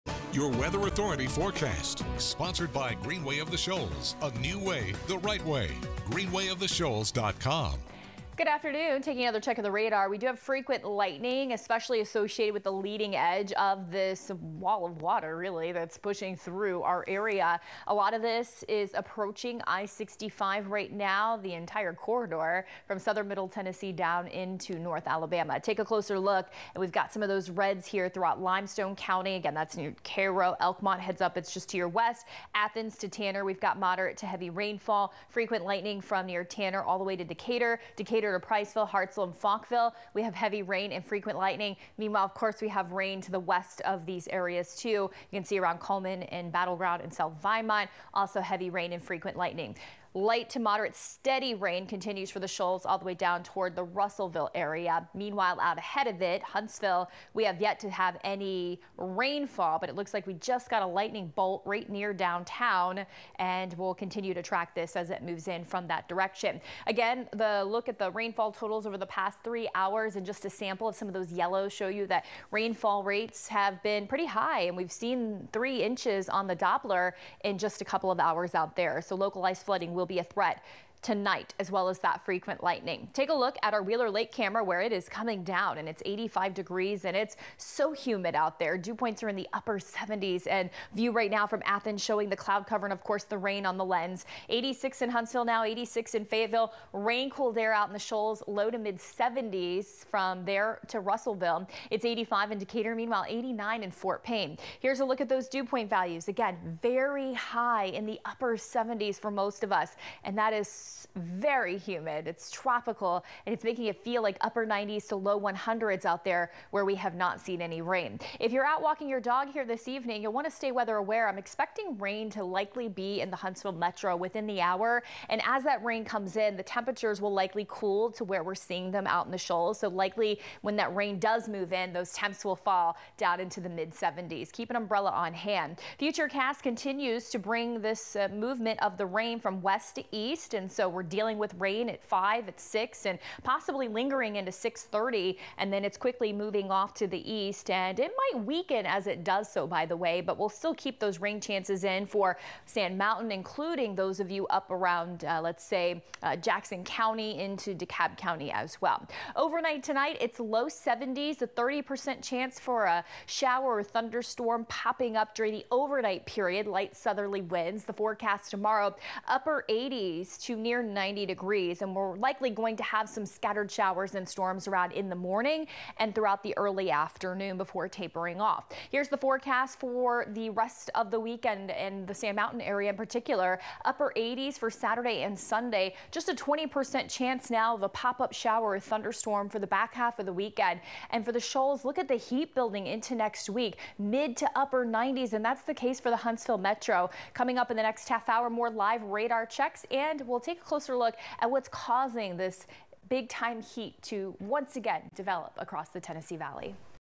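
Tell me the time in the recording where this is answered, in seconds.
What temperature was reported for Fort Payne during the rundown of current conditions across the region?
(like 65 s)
103 s.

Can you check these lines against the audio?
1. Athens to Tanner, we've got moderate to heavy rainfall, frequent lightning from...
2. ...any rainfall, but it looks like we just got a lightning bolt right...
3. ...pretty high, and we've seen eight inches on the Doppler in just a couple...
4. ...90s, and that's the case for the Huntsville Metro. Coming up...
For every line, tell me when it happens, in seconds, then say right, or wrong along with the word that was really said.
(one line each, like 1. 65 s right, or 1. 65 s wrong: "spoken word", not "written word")
1. 32 s right
2. 58 s right
3. 74 s wrong: "three", not "eight"
4. 194 s right.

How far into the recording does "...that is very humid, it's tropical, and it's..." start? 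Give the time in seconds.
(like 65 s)
110 s.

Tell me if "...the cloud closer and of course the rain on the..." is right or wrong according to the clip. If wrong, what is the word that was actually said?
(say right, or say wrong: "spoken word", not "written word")
wrong: "cover", not "closer".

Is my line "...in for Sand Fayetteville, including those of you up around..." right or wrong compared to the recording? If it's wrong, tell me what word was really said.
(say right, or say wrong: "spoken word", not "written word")
wrong: "Mountain", not "Fayetteville".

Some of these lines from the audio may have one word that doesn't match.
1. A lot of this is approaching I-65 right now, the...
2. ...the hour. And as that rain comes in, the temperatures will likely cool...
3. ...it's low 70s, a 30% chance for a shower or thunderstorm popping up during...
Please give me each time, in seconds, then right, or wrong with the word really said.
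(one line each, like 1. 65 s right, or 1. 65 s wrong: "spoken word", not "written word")
1. 17 s right
2. 124 s right
3. 160 s right.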